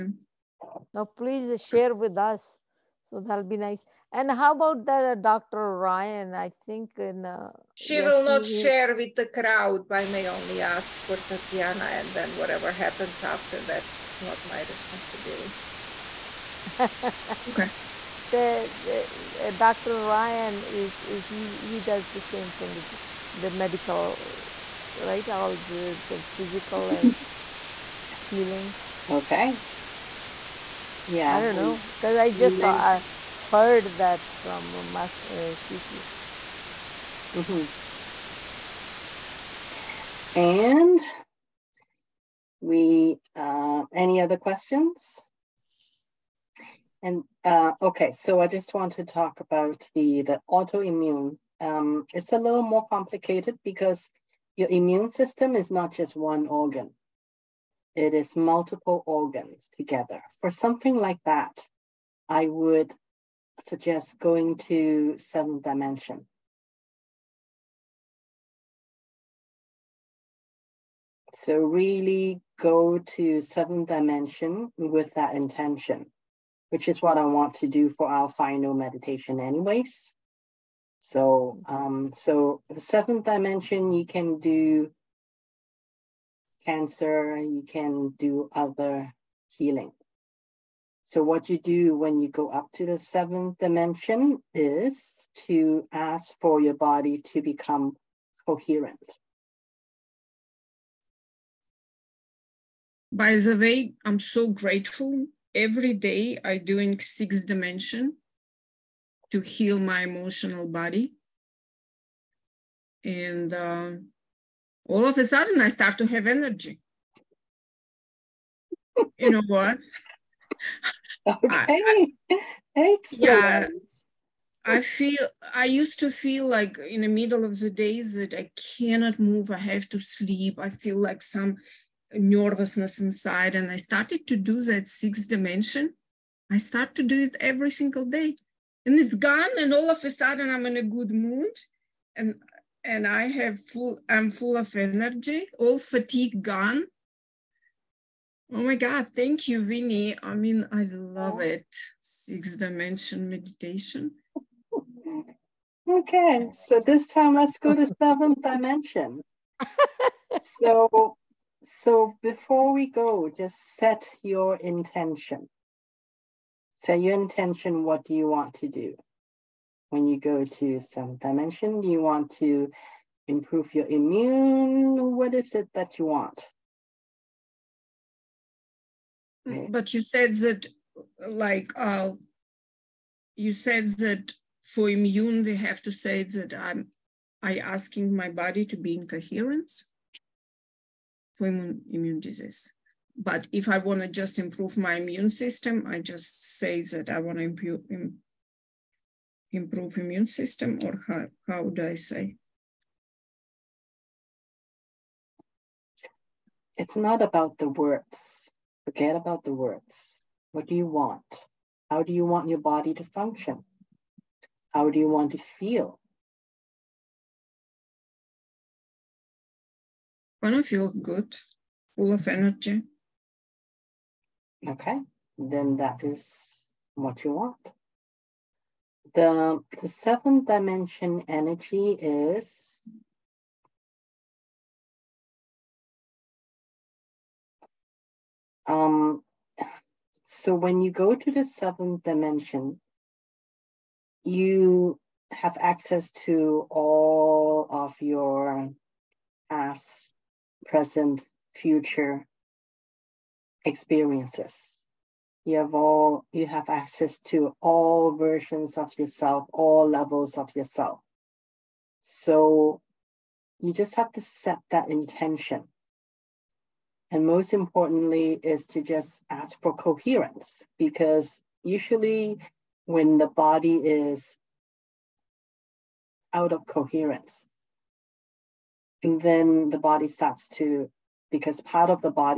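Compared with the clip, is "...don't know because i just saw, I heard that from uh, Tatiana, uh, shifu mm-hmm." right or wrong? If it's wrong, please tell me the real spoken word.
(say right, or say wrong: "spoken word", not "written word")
wrong: "Mas", not "Tatiana".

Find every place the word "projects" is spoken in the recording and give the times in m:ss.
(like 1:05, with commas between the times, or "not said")
not said.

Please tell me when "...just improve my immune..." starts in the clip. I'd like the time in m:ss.
3:14.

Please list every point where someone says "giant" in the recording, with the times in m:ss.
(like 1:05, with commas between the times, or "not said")
not said.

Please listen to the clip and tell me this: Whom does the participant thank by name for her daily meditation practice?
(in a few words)
Winnie.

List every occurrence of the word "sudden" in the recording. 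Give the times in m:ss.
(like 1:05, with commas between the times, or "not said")
1:55, 2:20.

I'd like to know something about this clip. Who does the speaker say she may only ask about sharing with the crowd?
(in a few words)
Tatiana.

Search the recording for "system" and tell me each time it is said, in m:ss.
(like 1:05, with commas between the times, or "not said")
0:55, 3:15, 3:20.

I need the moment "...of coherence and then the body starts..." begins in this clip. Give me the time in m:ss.
4:36.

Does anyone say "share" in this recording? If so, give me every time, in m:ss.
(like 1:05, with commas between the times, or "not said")
0:01, 0:08.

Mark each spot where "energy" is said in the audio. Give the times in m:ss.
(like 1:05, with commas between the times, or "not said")
1:56, 2:24, 3:42, 3:51.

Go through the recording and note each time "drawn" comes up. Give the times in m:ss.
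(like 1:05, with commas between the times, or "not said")
not said.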